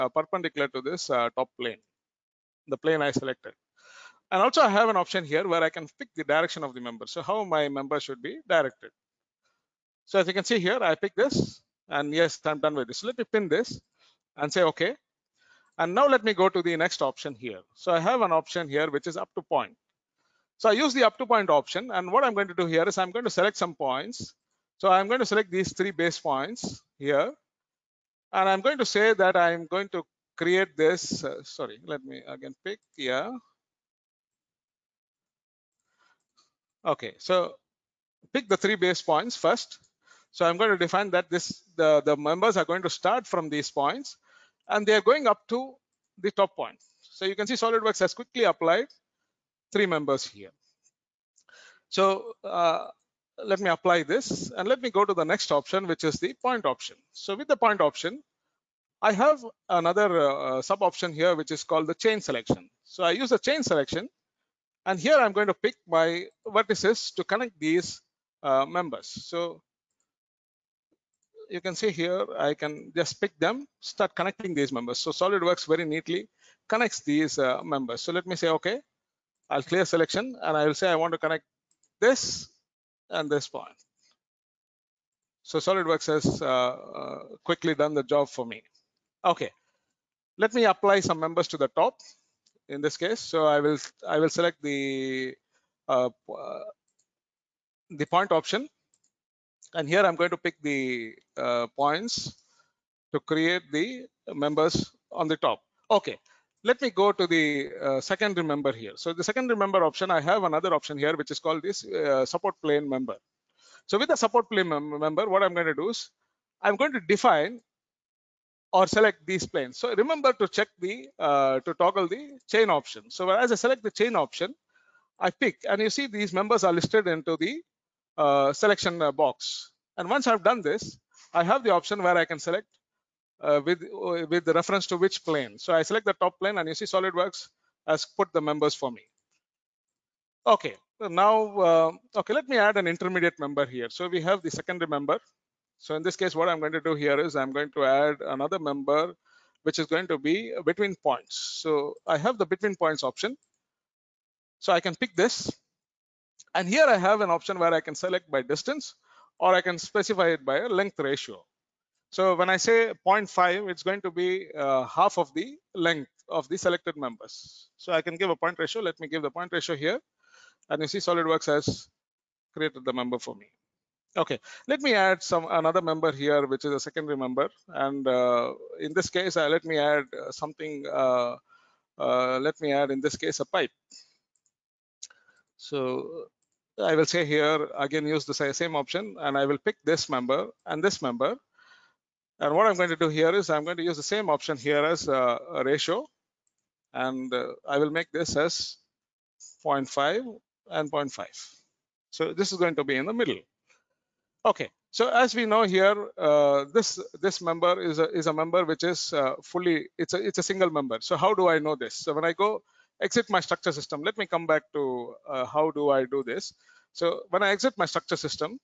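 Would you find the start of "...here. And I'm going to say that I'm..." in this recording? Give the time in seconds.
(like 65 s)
26 s.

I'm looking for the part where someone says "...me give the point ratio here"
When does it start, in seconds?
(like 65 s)
168 s.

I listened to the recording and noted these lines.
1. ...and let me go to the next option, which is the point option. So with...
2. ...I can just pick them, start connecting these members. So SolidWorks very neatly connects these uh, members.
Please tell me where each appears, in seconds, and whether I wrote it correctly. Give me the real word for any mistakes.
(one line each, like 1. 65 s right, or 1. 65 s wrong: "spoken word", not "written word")
1. 54 s right
2. 72 s right.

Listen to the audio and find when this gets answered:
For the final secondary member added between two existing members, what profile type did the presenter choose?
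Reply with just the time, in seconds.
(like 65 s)
183 s.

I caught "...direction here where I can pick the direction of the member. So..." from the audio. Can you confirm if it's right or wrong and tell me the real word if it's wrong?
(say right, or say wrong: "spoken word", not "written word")
wrong: "option", not "direction".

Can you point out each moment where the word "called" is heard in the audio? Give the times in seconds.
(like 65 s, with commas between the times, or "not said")
61 s, 111 s.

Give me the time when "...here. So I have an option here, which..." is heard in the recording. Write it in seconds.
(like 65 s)
17 s.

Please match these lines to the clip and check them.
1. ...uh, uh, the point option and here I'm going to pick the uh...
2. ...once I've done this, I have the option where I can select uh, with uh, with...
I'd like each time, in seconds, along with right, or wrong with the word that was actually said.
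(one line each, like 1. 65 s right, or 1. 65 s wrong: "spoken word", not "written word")
1. 95 s right
2. 130 s right.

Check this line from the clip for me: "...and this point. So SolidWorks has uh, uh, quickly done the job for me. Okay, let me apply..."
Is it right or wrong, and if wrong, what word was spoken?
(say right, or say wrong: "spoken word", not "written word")
right.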